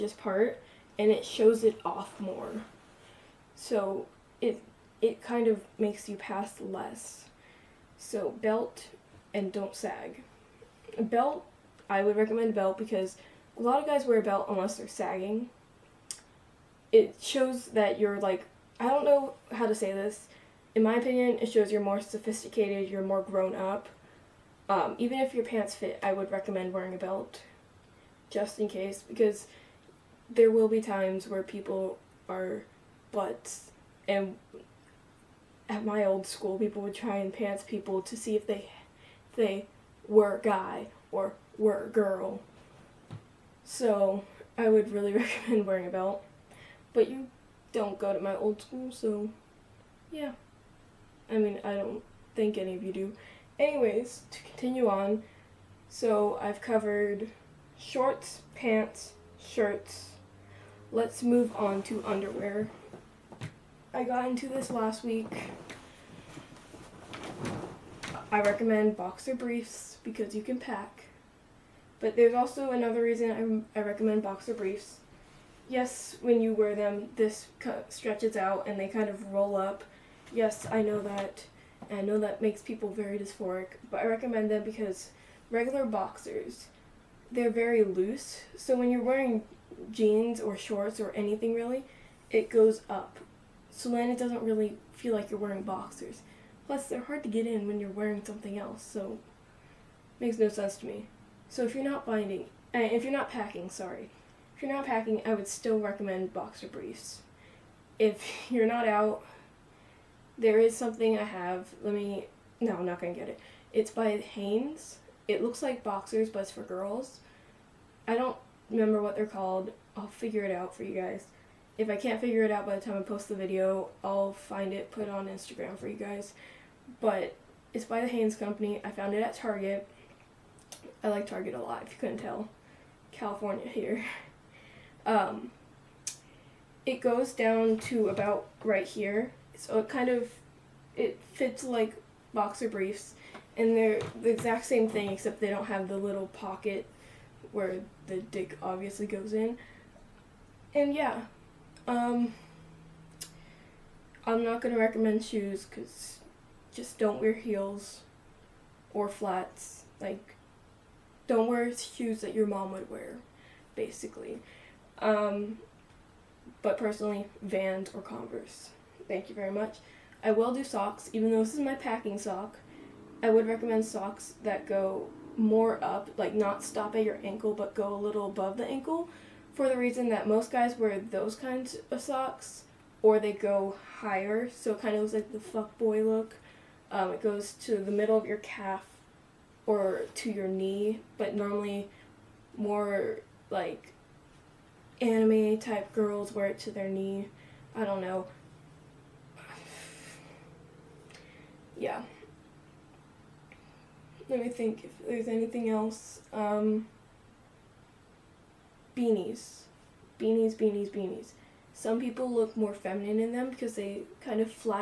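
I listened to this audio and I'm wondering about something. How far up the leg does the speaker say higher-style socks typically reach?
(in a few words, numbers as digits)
middle of your calf.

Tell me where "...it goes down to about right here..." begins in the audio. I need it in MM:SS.
02:16.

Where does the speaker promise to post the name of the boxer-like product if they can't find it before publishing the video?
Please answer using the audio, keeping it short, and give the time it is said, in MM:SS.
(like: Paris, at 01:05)
Instagram, at 02:05.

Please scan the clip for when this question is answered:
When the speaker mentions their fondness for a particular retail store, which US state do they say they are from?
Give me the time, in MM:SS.
02:13.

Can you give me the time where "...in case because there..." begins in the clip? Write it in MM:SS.
00:28.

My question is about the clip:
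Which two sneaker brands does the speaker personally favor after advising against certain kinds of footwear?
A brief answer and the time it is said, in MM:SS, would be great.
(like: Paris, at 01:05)
Vans or Converse, at 02:47.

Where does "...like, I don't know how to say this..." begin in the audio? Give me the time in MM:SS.
00:18.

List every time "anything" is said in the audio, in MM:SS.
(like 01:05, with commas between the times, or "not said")
01:31, 03:25.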